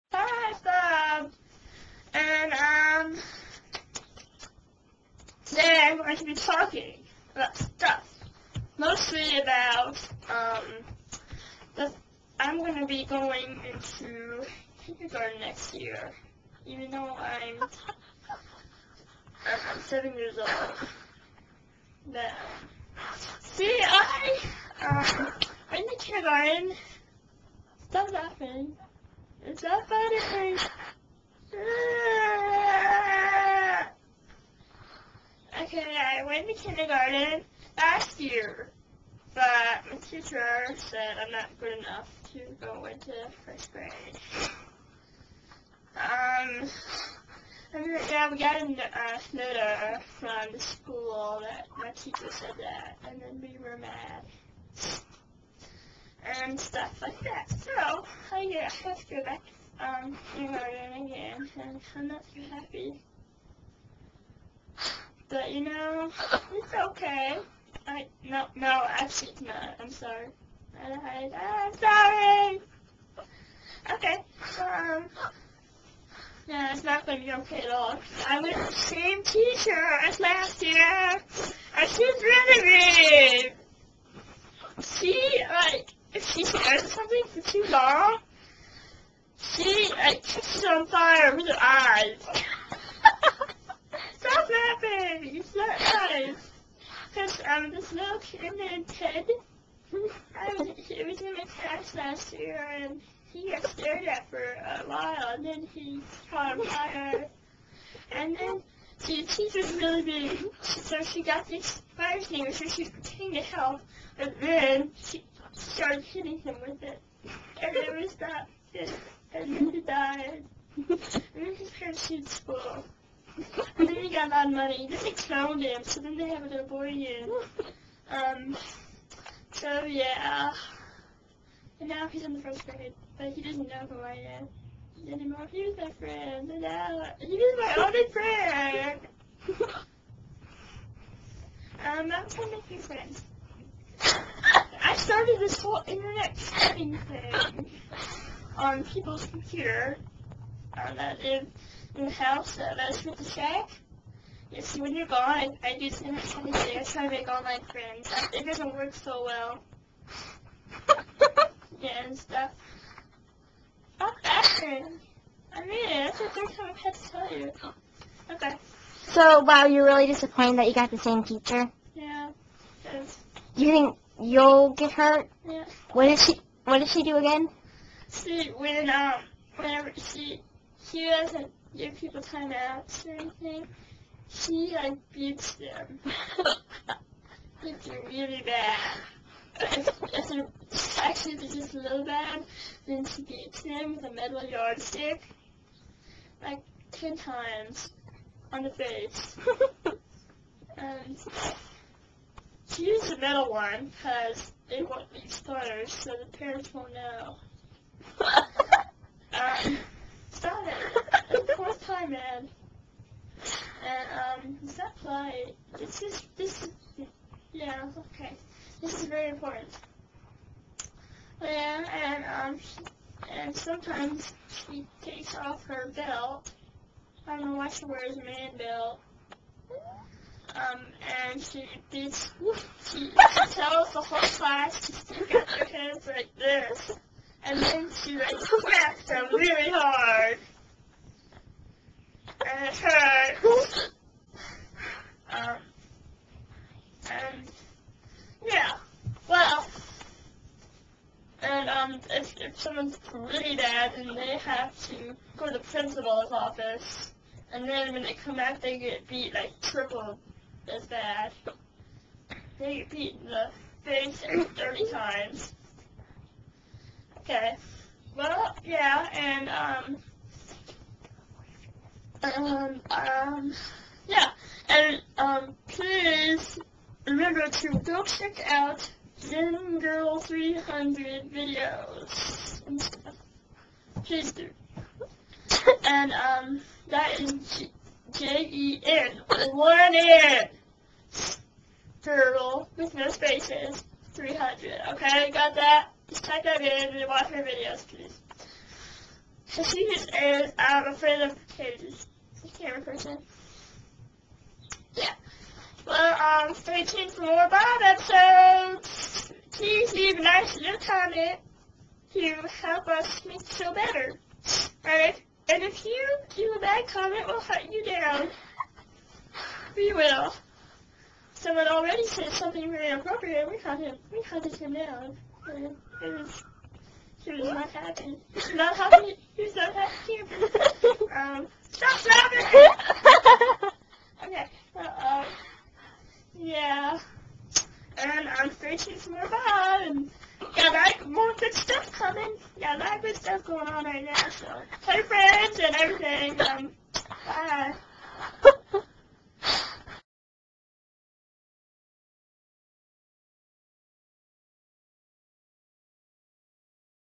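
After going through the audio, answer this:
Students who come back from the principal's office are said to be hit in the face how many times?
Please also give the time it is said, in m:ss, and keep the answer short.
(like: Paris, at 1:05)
30, at 4:24.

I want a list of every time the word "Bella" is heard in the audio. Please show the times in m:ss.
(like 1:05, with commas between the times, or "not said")
not said.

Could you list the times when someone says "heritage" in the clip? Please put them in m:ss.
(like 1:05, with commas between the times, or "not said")
not said.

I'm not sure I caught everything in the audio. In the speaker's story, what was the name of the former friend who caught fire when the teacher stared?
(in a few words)
Ted.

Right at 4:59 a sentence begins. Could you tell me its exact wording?
So secret is I'm afraid of his, Camera person.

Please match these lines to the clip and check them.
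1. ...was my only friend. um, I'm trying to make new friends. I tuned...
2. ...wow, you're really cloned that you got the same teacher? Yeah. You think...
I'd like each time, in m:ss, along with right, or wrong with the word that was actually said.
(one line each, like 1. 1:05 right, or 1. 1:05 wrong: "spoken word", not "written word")
1. 2:17 wrong: "started", not "tuned"
2. 2:49 wrong: "disappointed", not "cloned".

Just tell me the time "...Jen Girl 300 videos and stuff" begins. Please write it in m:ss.
4:39.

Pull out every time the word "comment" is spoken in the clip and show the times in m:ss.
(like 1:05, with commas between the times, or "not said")
5:10, 5:16.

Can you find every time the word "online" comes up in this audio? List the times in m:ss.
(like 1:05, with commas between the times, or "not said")
2:37.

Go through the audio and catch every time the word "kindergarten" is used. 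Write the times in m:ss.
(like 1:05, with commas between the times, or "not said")
0:14, 0:25, 0:36, 1:00.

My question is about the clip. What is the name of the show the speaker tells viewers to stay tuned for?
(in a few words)
Bob.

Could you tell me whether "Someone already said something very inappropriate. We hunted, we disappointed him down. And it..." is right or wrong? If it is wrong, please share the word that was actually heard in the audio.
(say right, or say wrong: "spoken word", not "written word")
wrong: "hunted", not "disappointed".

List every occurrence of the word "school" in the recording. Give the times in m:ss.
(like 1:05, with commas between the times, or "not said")
0:50, 2:02.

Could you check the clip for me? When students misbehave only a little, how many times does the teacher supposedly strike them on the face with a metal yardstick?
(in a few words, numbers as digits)
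10.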